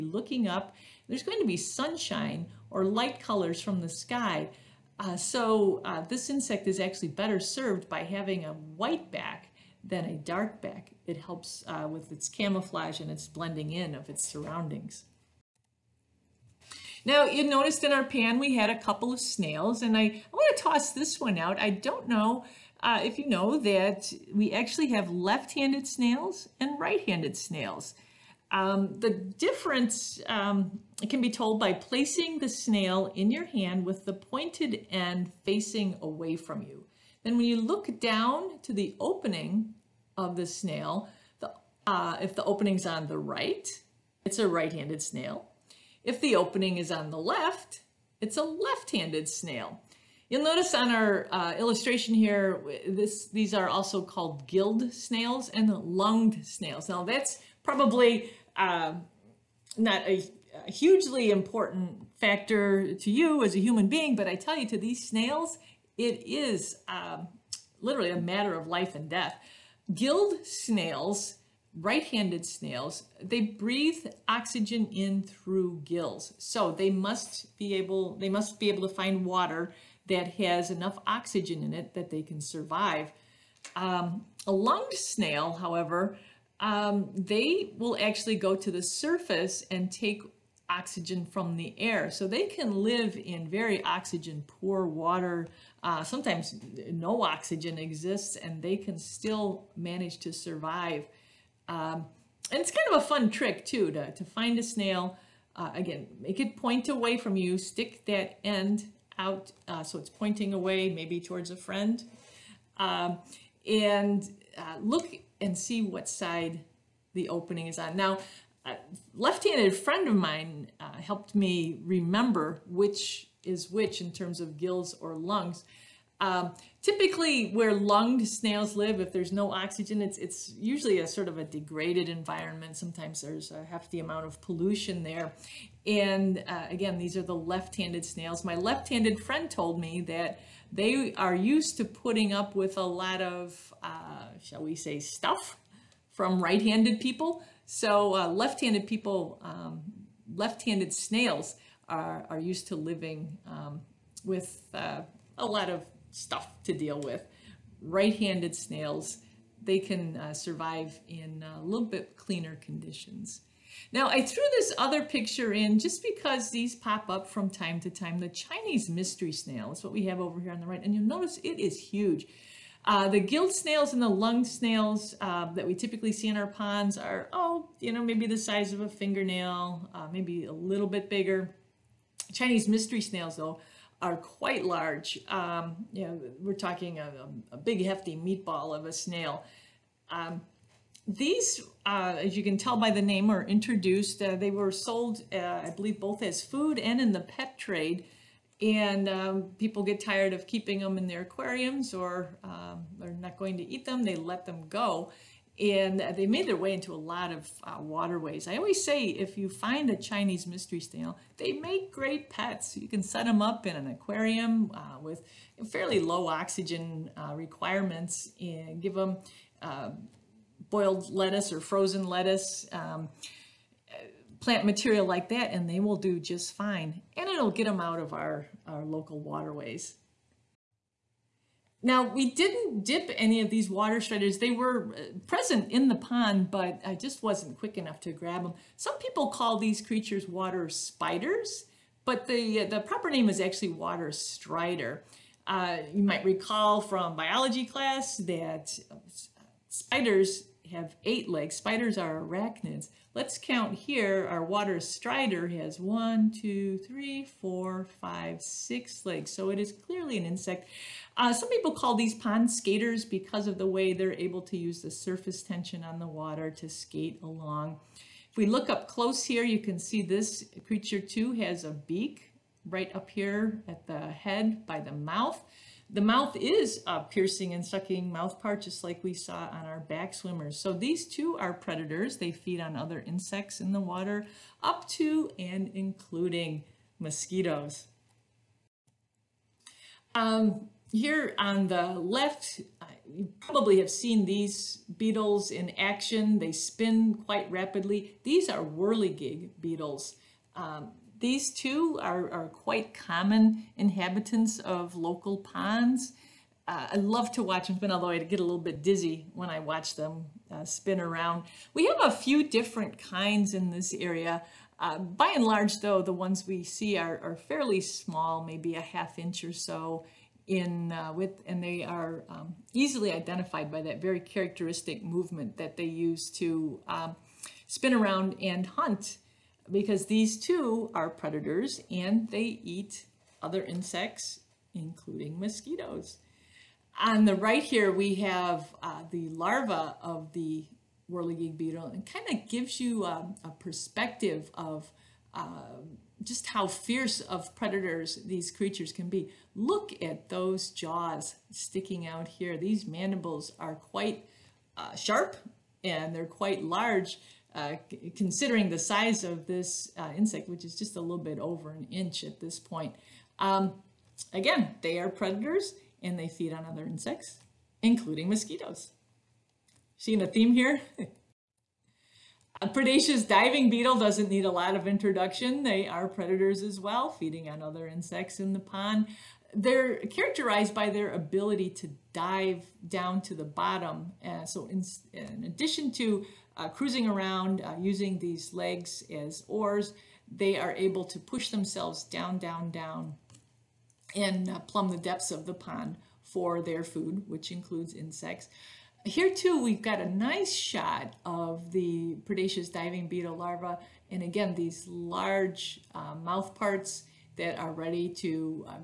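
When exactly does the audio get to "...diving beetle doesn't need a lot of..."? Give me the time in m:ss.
6:13.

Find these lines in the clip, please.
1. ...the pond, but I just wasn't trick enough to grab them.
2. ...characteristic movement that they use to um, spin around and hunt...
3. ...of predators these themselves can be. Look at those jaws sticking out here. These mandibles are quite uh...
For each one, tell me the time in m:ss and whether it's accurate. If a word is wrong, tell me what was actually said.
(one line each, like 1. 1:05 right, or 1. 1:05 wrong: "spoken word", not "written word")
1. 3:55 wrong: "quick", not "trick"
2. 5:24 right
3. 5:47 wrong: "creatures", not "themselves".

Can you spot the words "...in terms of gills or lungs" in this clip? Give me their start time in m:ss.
2:04.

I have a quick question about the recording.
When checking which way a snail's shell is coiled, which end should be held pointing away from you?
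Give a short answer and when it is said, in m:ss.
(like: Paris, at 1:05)
The pointed end, at 0:34.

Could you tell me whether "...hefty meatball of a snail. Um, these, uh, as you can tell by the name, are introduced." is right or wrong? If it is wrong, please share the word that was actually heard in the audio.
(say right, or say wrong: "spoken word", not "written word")
right.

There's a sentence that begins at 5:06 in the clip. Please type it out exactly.
Uh, I love to watch them spin, although I get a little bit dizzy when I watch them uh, spin around.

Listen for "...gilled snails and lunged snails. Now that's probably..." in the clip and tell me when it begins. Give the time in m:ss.
0:54.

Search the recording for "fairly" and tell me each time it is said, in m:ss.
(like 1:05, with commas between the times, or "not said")
3:35, 5:17.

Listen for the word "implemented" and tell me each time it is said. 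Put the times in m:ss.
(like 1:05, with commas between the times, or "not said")
not said.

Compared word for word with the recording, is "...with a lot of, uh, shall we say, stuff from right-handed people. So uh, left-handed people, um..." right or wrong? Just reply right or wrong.
right.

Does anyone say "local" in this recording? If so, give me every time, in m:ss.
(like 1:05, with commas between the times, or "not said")
3:48, 5:04.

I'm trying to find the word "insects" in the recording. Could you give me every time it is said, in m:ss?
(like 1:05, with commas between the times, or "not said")
0:06, 4:20, 4:43, 5:33, 6:00, 6:06, 6:17, 6:37.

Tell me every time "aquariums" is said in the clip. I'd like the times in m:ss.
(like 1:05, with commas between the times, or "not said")
3:21, 3:33.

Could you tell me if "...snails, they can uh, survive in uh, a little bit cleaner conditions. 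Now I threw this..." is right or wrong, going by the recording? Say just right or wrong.
right.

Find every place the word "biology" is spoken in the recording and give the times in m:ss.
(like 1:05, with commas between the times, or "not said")
4:07.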